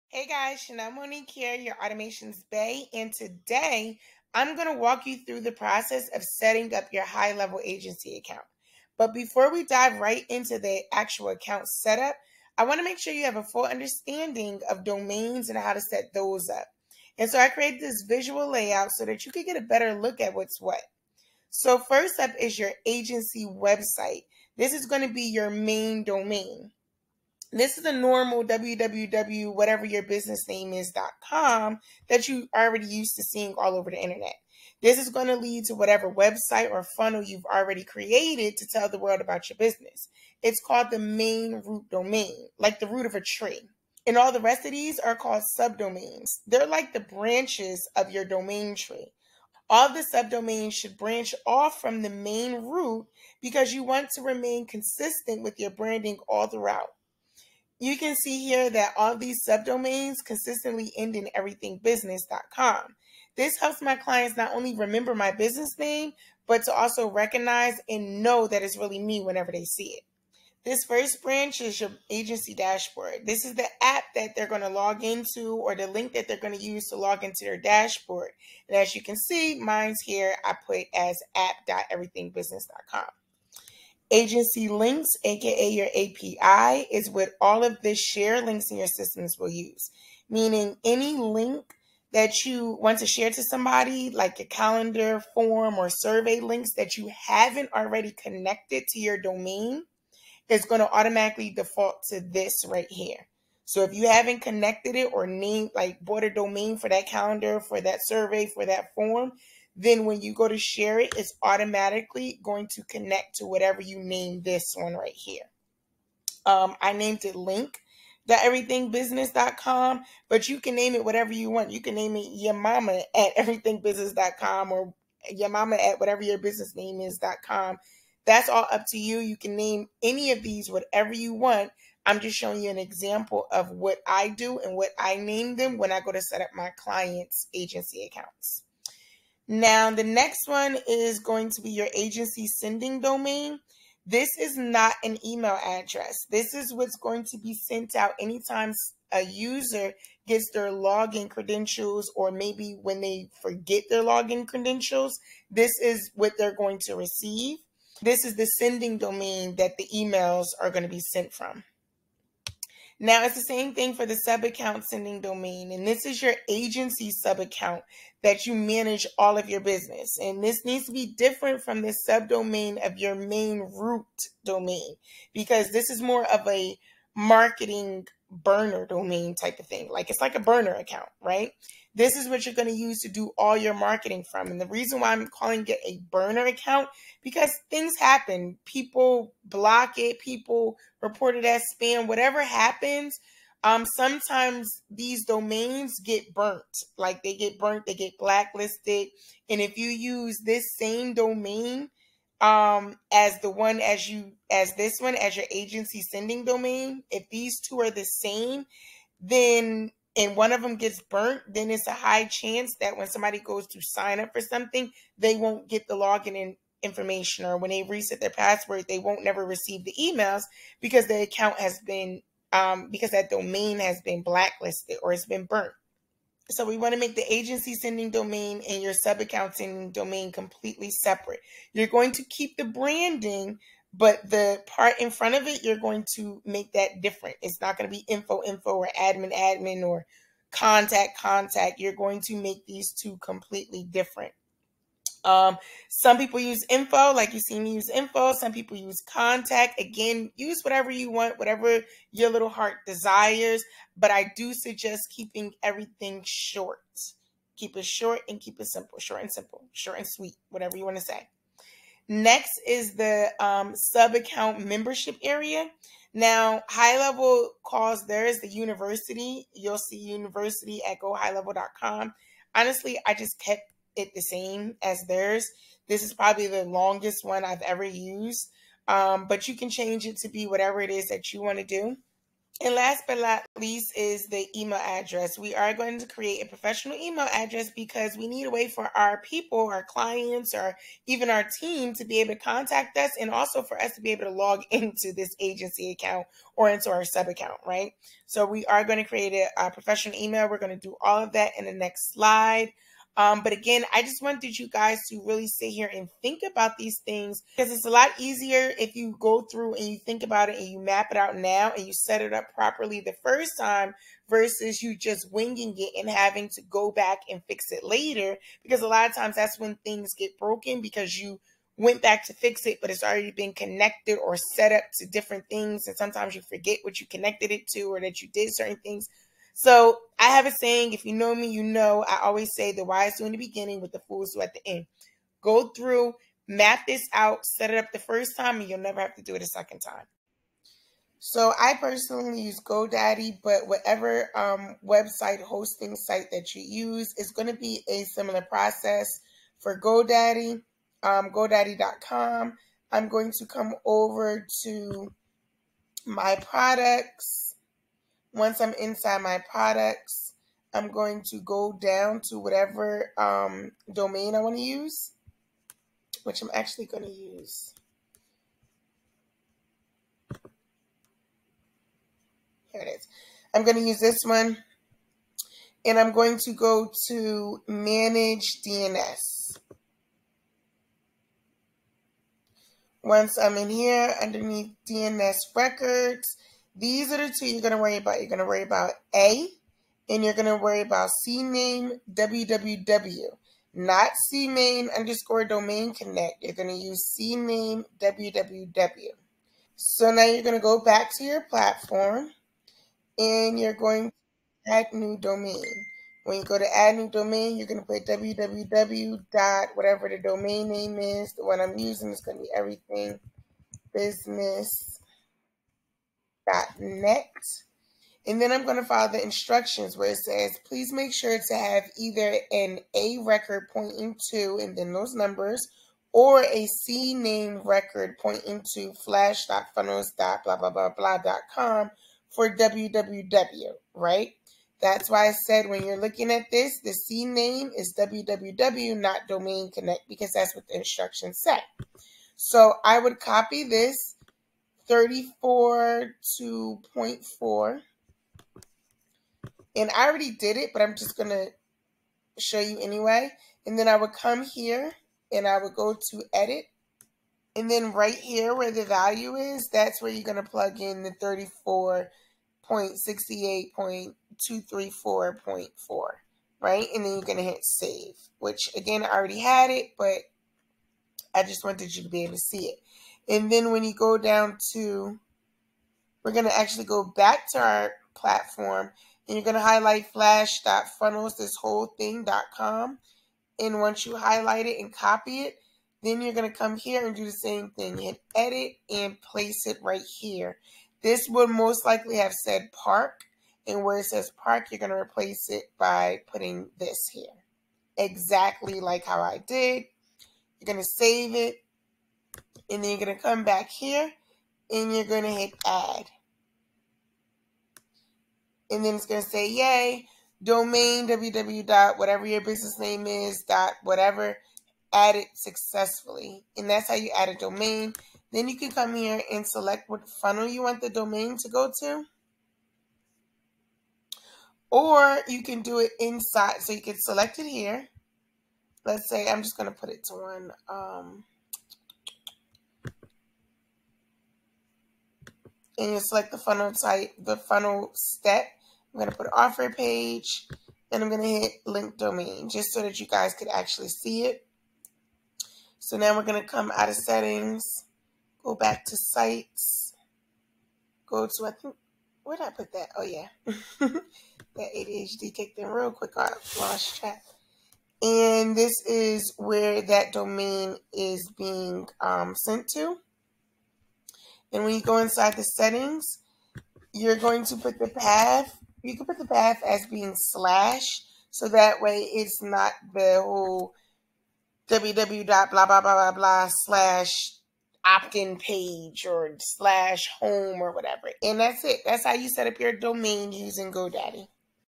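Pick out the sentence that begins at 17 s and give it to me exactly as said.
And so I created this visual layout so that you can get a better look at what's what.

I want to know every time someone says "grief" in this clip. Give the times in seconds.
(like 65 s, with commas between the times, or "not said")
not said.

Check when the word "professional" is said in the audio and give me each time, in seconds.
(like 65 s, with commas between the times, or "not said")
286 s, 299 s.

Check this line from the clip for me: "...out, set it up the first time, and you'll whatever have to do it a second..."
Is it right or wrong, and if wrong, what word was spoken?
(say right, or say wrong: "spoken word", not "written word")
wrong: "never", not "whatever".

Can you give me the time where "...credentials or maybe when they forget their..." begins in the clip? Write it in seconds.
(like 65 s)
151 s.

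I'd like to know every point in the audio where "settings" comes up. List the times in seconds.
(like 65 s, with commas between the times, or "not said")
6 s, 546 s, 565 s.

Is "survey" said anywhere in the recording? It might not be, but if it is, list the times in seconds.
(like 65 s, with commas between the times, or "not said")
95 s, 108 s.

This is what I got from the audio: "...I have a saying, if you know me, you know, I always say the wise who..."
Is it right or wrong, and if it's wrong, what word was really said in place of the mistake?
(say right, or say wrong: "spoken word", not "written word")
right.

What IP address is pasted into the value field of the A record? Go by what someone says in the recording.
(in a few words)
34.68.234.4.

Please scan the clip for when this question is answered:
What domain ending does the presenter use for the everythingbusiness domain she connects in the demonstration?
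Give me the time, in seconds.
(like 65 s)
412 s.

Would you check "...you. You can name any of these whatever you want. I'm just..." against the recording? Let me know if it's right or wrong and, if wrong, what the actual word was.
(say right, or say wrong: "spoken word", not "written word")
right.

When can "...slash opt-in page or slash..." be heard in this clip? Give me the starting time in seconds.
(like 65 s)
576 s.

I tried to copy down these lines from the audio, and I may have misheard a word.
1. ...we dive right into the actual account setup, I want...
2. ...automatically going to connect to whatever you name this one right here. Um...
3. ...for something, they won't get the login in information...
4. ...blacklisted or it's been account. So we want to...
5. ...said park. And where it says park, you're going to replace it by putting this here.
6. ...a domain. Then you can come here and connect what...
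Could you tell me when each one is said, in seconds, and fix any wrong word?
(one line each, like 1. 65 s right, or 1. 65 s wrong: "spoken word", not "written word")
1. 9 s right
2. 111 s right
3. 214 s right
4. 224 s wrong: "burnt", not "account"
5. 492 s right
6. 517 s wrong: "select", not "connect".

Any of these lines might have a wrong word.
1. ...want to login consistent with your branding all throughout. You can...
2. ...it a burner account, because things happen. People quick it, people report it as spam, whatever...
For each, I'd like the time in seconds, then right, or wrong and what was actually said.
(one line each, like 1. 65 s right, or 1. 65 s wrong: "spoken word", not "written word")
1. 53 s wrong: "remain", not "login"
2. 185 s wrong: "block", not "quick".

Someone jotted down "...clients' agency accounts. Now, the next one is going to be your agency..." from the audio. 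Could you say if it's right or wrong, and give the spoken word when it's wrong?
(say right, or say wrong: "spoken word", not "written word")
right.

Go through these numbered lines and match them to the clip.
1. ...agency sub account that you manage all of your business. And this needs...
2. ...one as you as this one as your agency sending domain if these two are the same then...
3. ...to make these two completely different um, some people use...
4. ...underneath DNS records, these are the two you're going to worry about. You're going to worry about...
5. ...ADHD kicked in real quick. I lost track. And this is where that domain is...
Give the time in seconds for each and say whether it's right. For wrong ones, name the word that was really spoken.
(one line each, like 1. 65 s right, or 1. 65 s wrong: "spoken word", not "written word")
1. 166 s right
2. 203 s right
3. 242 s right
4. 384 s right
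5. 554 s right.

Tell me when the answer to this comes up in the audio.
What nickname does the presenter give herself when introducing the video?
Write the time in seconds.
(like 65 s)
1 s.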